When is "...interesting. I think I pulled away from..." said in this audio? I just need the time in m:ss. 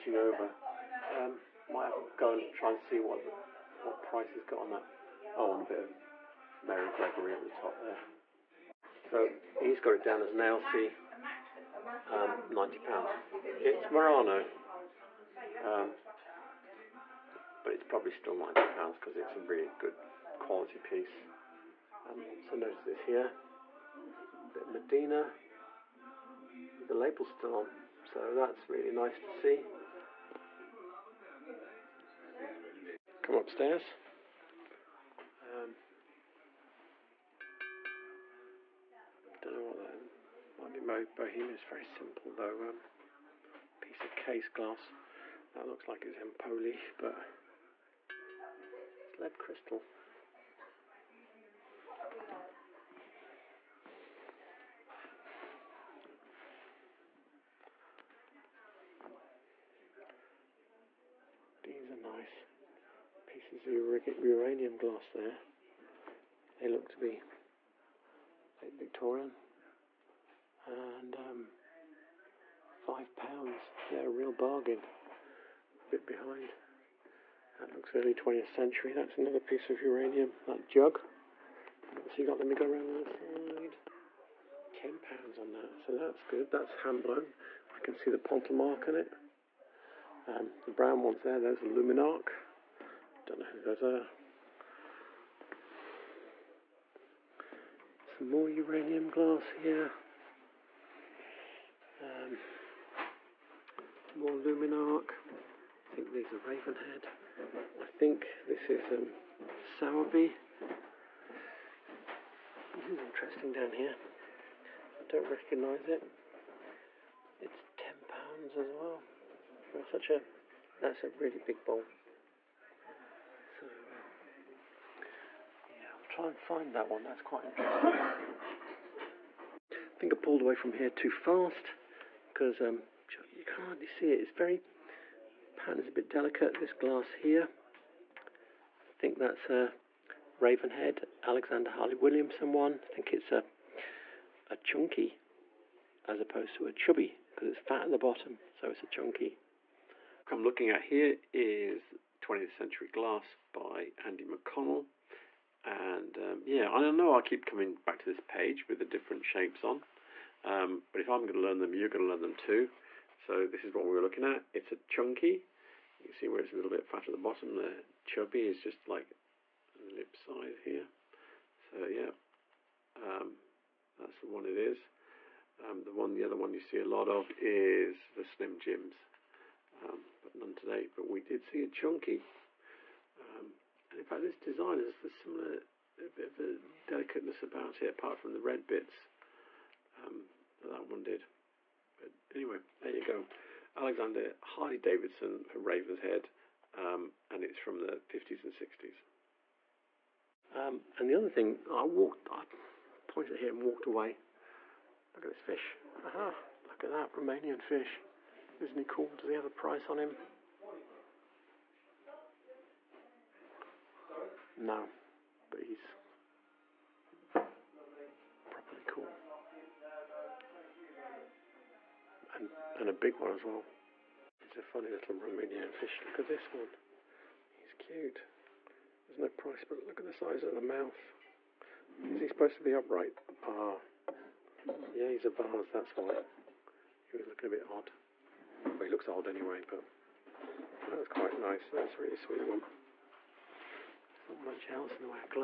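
2:07.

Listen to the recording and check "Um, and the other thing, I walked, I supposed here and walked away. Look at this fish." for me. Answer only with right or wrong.
wrong.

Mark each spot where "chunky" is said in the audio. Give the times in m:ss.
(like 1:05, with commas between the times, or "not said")
2:24, 2:28, 2:44, 3:01.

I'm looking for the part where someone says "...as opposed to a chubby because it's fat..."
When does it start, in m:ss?
2:26.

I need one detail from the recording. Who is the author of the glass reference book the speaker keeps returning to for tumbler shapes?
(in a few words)
Andy McConnell.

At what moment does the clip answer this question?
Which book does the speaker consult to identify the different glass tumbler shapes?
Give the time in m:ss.
2:32.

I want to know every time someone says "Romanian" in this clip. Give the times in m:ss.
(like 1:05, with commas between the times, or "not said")
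3:27, 3:45.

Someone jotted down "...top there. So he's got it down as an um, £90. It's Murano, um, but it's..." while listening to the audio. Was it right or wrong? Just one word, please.
right.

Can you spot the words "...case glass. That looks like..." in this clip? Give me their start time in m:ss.
0:44.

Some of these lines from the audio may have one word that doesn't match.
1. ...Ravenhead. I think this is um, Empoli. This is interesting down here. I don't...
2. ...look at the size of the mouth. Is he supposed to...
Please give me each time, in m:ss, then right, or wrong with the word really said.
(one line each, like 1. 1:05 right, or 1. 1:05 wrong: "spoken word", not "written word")
1. 1:46 wrong: "Sowerby", not "Empoli"
2. 3:49 right.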